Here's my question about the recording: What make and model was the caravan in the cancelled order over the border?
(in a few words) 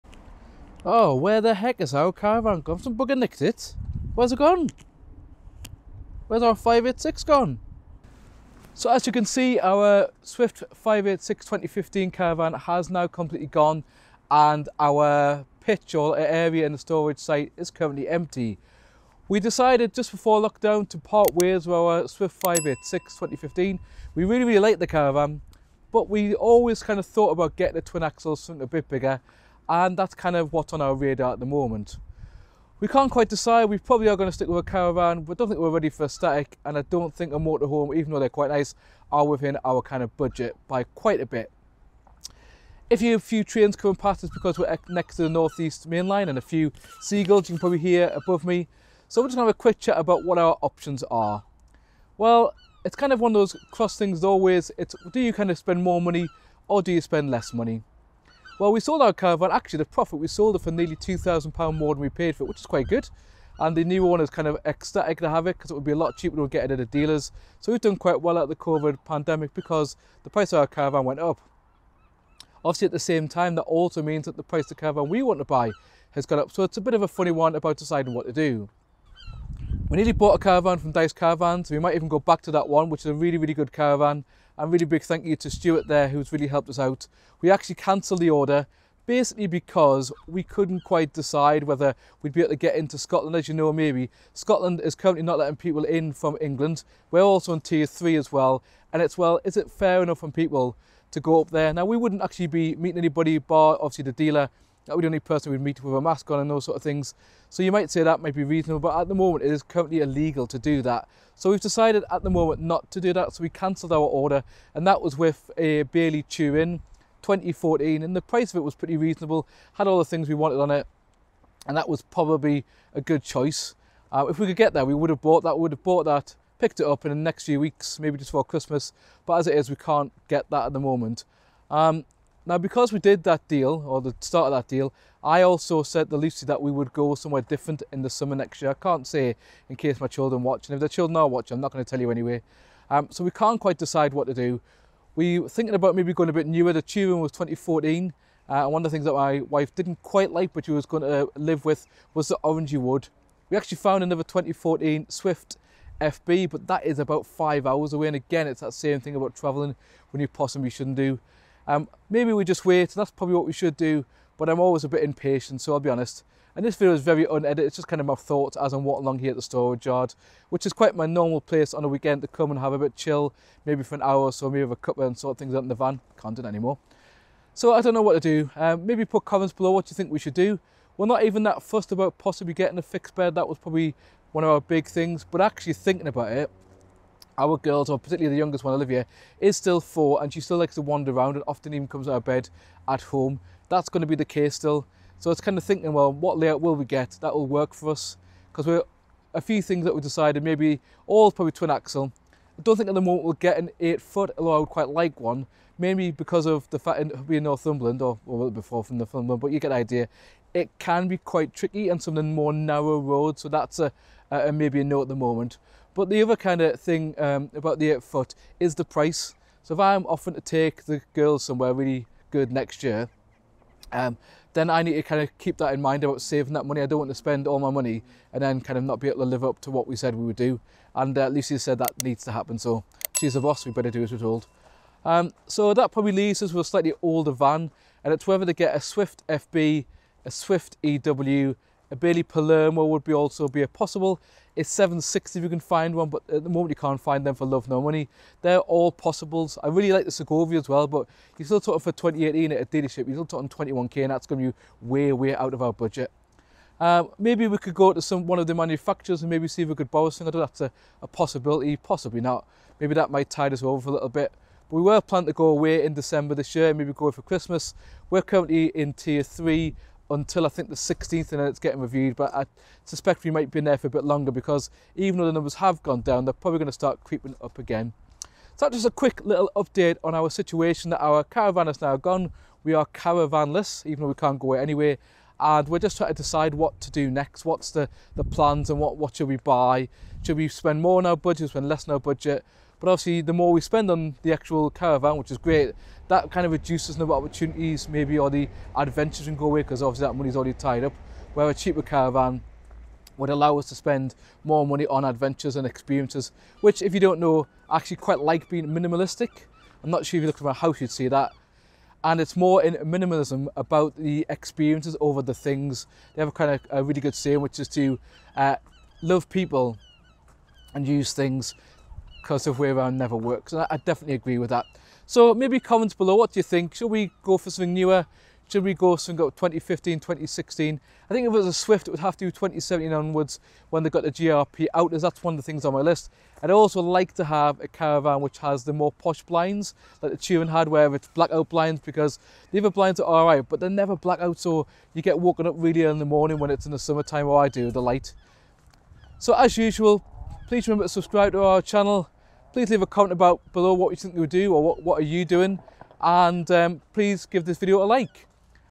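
Bailey Turin.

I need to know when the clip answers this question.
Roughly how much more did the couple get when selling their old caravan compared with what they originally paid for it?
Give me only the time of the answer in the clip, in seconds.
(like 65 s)
60 s.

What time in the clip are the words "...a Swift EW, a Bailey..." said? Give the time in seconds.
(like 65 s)
240 s.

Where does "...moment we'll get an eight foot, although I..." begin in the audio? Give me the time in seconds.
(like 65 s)
203 s.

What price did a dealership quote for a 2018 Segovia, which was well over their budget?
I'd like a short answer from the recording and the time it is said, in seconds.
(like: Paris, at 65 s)
21k, at 253 s.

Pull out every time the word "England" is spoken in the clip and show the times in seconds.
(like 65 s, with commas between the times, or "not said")
96 s.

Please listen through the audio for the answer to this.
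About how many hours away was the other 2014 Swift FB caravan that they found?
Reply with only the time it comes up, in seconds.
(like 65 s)
157 s.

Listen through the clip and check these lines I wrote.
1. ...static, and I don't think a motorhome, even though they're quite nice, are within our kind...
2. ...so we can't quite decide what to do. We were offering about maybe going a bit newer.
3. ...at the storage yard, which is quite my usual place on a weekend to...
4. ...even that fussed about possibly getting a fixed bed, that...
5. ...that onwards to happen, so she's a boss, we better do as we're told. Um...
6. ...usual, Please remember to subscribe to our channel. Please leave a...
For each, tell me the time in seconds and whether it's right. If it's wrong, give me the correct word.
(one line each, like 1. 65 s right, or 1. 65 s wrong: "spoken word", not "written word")
1. 36 s right
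2. 143 s wrong: "thinking", not "offering"
3. 169 s wrong: "normal", not "usual"
4. 181 s right
5. 231 s wrong: "needs", not "onwards"
6. 349 s right.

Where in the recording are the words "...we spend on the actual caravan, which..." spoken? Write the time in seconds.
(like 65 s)
293 s.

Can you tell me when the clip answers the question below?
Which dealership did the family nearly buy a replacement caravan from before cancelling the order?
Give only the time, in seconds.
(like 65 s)
80 s.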